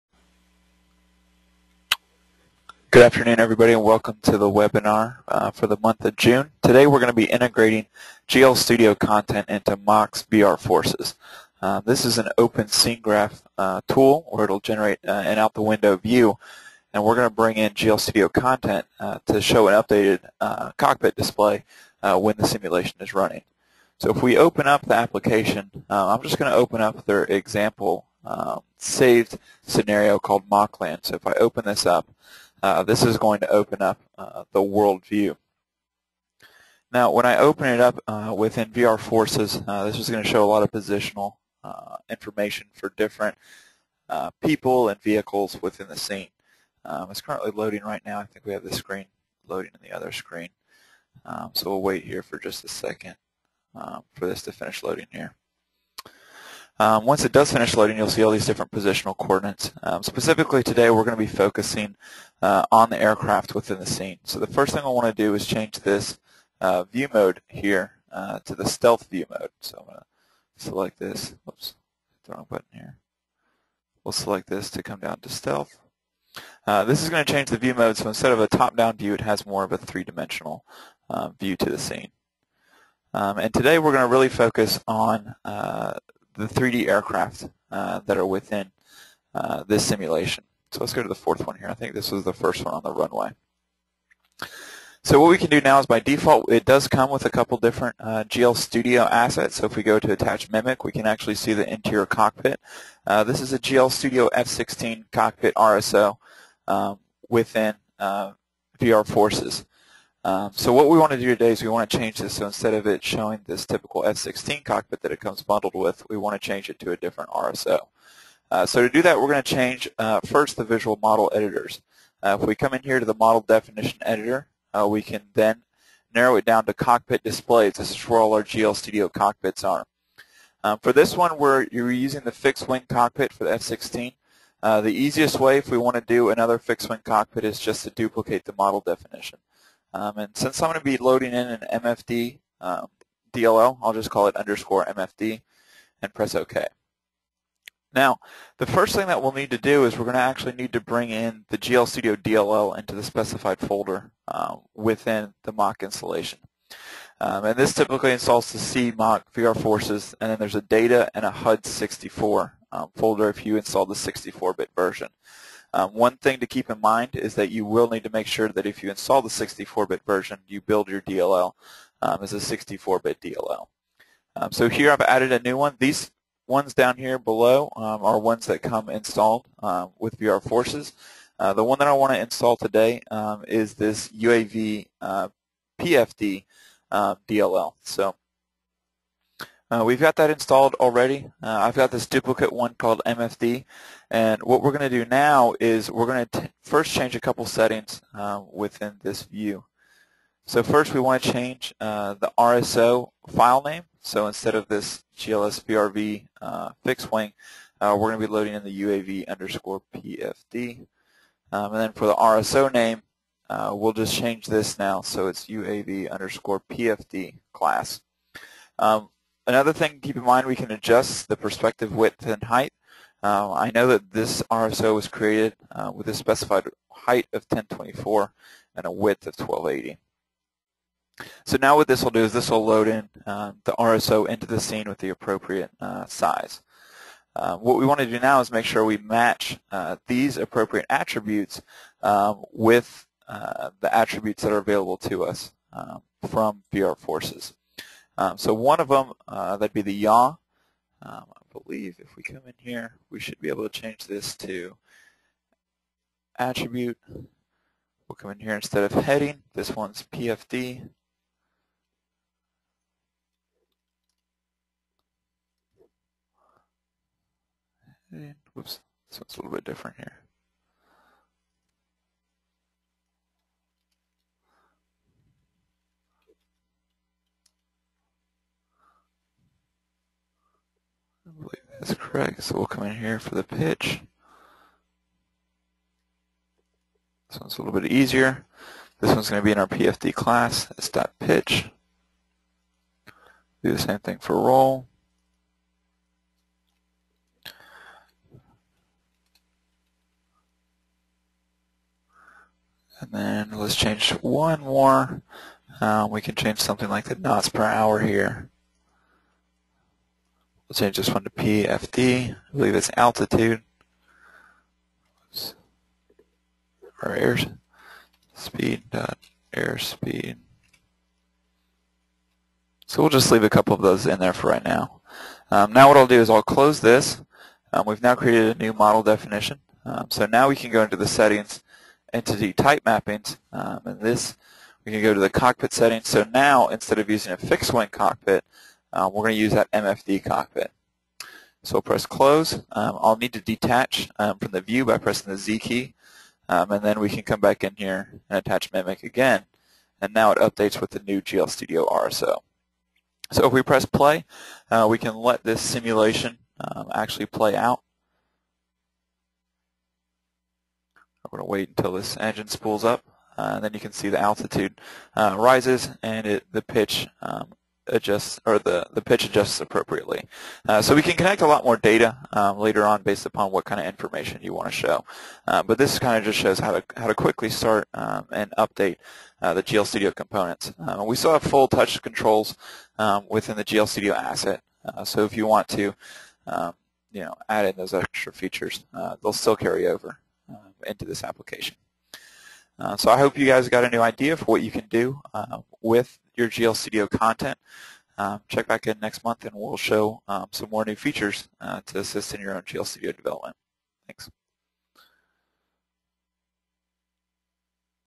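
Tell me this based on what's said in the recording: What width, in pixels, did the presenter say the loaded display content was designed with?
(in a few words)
1280.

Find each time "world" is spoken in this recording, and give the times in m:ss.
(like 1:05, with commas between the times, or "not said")
0:34.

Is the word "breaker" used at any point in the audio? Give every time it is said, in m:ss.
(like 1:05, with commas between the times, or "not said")
not said.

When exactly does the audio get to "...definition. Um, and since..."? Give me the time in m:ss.
2:18.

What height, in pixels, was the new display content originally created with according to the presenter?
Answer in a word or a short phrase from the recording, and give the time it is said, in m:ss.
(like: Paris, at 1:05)
1024, at 3:47.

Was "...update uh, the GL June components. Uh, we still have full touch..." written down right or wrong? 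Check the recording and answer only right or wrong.
wrong.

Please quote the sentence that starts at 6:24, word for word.
Uh, so if you want to um, you know, add in those extra features, uh, they'll still carry over into this application.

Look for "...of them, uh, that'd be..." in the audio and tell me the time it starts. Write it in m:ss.
4:08.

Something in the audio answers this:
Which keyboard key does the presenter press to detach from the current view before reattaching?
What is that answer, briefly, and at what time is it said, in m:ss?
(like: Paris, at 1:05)
Z, at 5:45.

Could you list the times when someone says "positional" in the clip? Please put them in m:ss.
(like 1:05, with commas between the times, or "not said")
0:40, 0:58.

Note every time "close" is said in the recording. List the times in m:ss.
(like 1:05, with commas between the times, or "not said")
5:26, 5:42.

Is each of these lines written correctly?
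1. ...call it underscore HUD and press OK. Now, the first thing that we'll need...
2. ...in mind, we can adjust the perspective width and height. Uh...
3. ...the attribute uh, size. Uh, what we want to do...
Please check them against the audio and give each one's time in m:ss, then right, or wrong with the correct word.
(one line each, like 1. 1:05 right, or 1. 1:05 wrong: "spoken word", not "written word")
1. 2:24 wrong: "MFD", not "HUD"
2. 3:40 right
3. 3:54 wrong: "appropriate", not "attribute".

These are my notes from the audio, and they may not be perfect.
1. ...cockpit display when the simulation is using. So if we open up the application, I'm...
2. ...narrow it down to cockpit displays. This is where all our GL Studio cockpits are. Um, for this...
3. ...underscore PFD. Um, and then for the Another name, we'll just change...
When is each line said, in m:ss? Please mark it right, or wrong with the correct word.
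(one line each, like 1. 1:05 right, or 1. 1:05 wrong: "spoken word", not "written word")
1. 0:20 wrong: "running", not "using"
2. 2:06 right
3. 3:29 wrong: "RSO", not "Another".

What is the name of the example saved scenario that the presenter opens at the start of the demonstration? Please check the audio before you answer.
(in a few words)
Mockland.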